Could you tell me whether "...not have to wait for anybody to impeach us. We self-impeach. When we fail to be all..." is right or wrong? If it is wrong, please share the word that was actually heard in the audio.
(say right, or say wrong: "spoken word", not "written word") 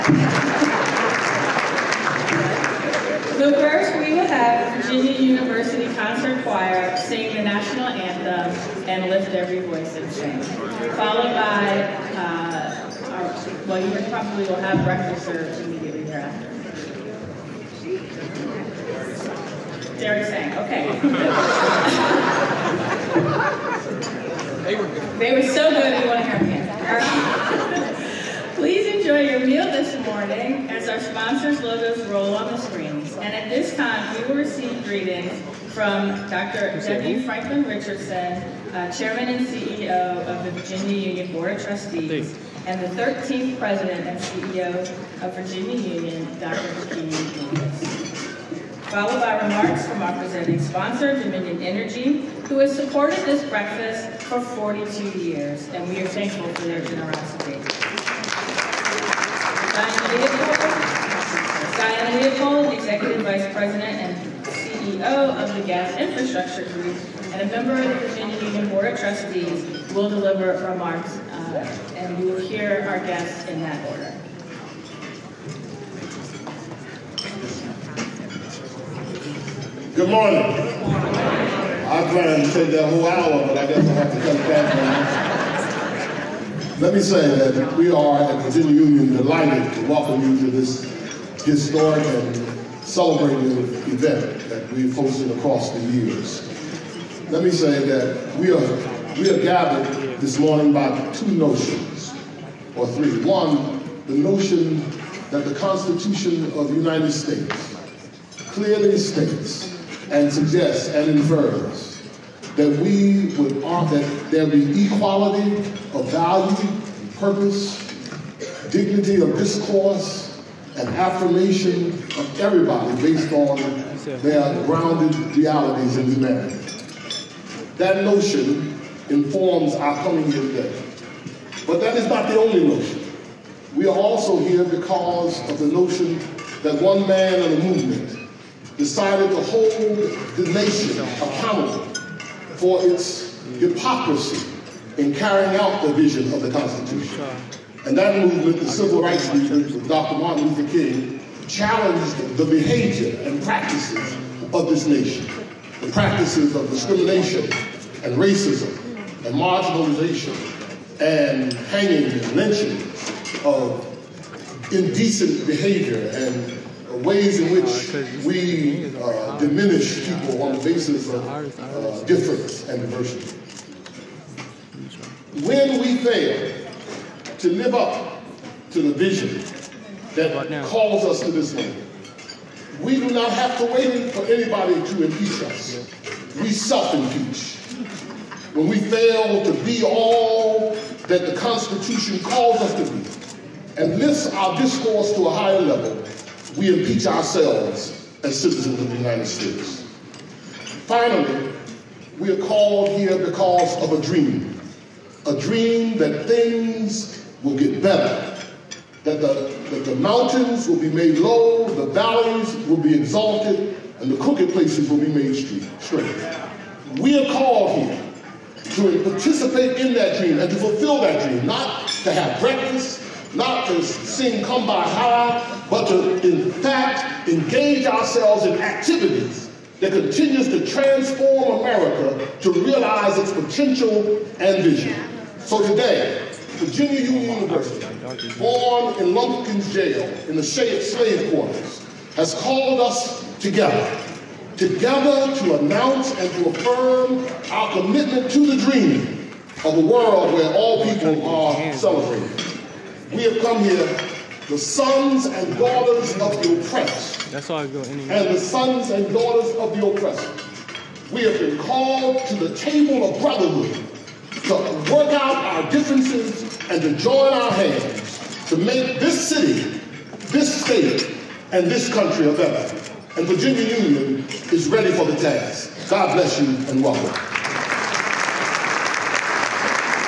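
right.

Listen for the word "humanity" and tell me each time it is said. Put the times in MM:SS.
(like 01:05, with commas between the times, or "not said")
02:06.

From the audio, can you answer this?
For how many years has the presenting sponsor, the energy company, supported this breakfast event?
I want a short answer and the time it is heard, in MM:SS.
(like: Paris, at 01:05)
42, at 00:54.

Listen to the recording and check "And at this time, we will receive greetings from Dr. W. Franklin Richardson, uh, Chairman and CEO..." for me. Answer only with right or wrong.
right.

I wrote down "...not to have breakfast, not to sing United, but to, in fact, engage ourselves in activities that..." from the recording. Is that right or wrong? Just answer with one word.
wrong.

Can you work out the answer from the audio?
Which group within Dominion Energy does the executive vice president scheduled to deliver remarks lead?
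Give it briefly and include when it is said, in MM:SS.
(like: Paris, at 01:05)
Gas Infrastructure Group, at 01:05.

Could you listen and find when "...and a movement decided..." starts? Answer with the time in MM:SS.
02:17.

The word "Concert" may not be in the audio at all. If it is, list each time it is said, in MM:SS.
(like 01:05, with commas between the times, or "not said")
00:05.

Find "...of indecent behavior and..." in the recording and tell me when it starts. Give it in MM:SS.
02:43.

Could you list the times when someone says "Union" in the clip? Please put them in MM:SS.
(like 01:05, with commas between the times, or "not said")
00:41, 00:45, 01:08, 01:28, 03:57, 04:33.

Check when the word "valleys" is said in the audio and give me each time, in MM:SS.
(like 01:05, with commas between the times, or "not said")
03:31.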